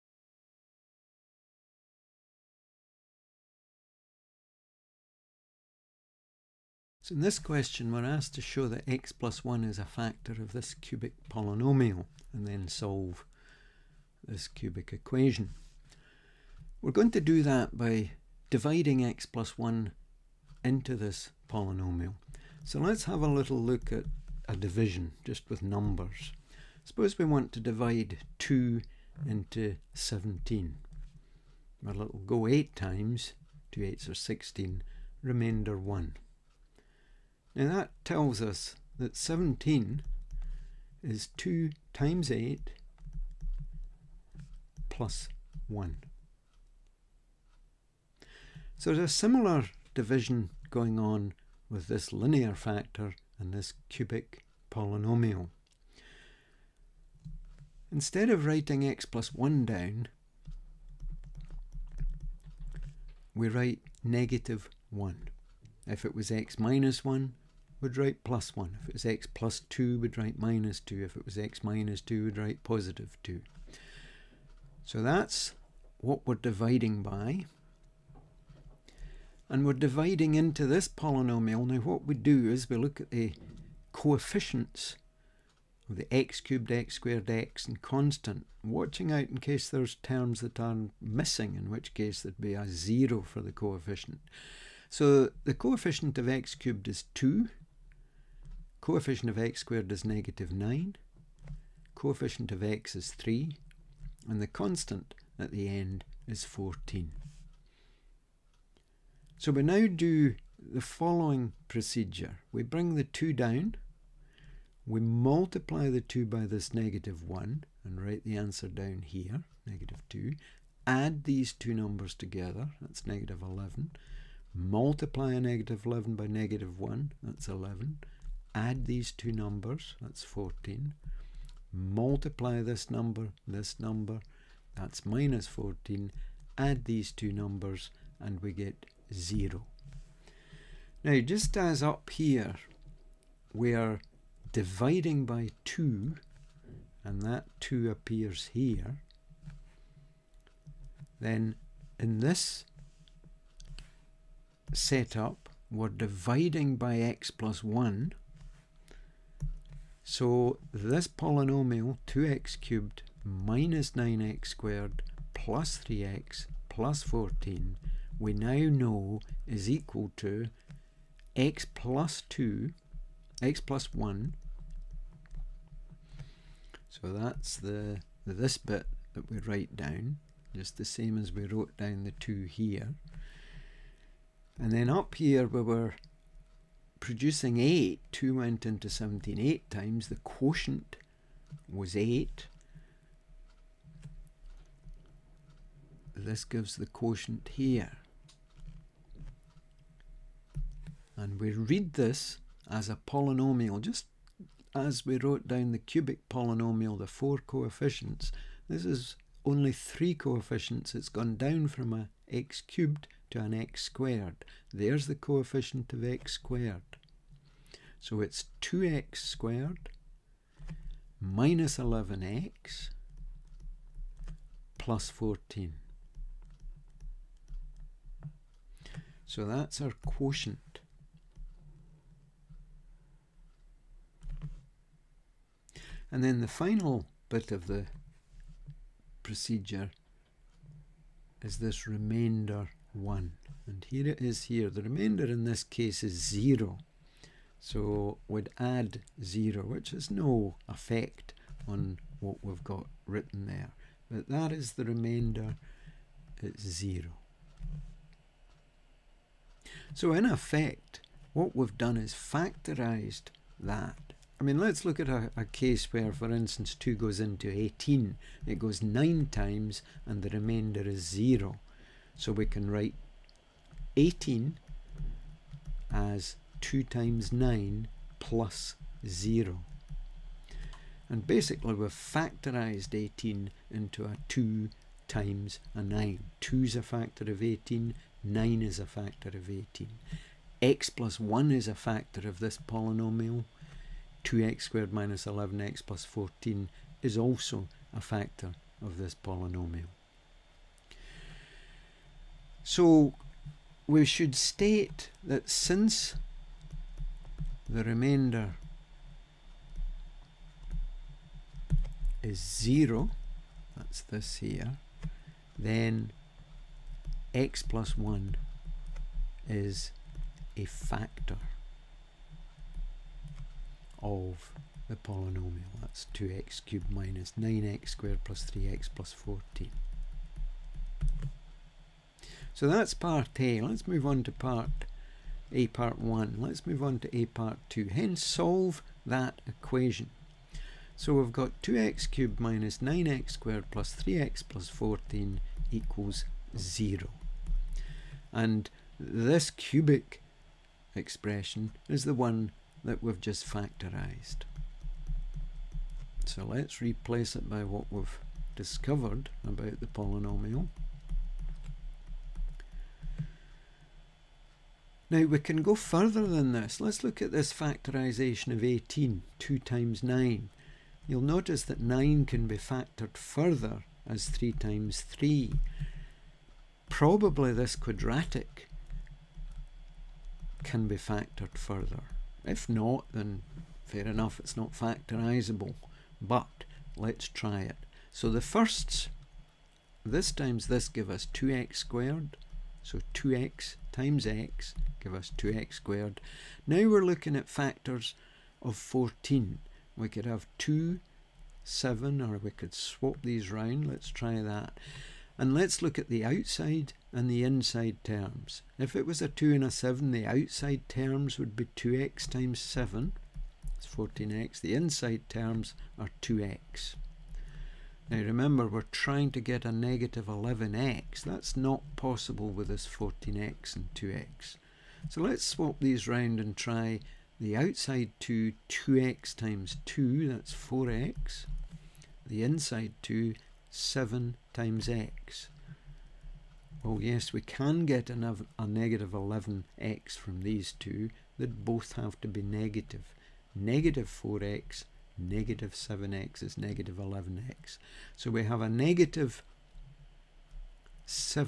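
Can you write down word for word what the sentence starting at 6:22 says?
If not, then fair enough, it's not factorisable.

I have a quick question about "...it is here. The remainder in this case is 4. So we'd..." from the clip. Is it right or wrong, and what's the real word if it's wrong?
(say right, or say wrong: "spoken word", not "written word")
wrong: "0", not "4".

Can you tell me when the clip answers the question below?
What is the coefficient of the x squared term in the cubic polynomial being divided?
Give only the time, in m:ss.
1:40.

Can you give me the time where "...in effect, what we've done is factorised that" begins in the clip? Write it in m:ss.
4:20.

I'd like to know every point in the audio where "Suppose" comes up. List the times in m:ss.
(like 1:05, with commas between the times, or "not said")
0:26.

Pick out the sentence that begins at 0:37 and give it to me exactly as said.
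Now that tells us that 17 is 2 times 8 plus 1.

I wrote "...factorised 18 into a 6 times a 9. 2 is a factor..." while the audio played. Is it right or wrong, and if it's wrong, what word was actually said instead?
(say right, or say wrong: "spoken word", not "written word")
wrong: "2", not "6".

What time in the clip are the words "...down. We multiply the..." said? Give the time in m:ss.
1:53.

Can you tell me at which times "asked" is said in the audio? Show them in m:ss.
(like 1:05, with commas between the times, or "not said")
0:08.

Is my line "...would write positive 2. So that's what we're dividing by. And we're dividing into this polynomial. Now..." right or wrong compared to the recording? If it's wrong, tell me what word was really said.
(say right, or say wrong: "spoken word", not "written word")
right.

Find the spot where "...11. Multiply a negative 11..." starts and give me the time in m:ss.
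2:03.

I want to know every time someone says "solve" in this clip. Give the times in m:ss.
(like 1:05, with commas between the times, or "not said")
0:12, 5:38.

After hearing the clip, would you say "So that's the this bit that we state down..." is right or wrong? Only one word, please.
wrong.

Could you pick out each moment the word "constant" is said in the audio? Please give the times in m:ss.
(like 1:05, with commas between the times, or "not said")
1:27, 1:44.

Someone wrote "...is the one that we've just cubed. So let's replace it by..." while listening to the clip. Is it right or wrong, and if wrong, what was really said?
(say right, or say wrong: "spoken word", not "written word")
wrong: "factorized", not "cubed".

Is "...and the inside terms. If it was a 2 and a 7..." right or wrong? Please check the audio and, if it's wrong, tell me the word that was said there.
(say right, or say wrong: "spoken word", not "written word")
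right.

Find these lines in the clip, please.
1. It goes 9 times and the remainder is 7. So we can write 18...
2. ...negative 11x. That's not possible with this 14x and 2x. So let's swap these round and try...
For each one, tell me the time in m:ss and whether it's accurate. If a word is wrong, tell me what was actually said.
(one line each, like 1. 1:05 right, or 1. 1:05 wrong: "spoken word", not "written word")
1. 4:28 wrong: "0", not "7"
2. 6:59 right.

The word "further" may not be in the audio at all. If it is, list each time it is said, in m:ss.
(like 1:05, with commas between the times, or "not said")
6:05, 6:13, 6:21.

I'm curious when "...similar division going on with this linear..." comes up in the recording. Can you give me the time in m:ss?
0:49.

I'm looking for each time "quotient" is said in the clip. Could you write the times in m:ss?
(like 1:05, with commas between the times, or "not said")
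3:10, 3:16, 3:50.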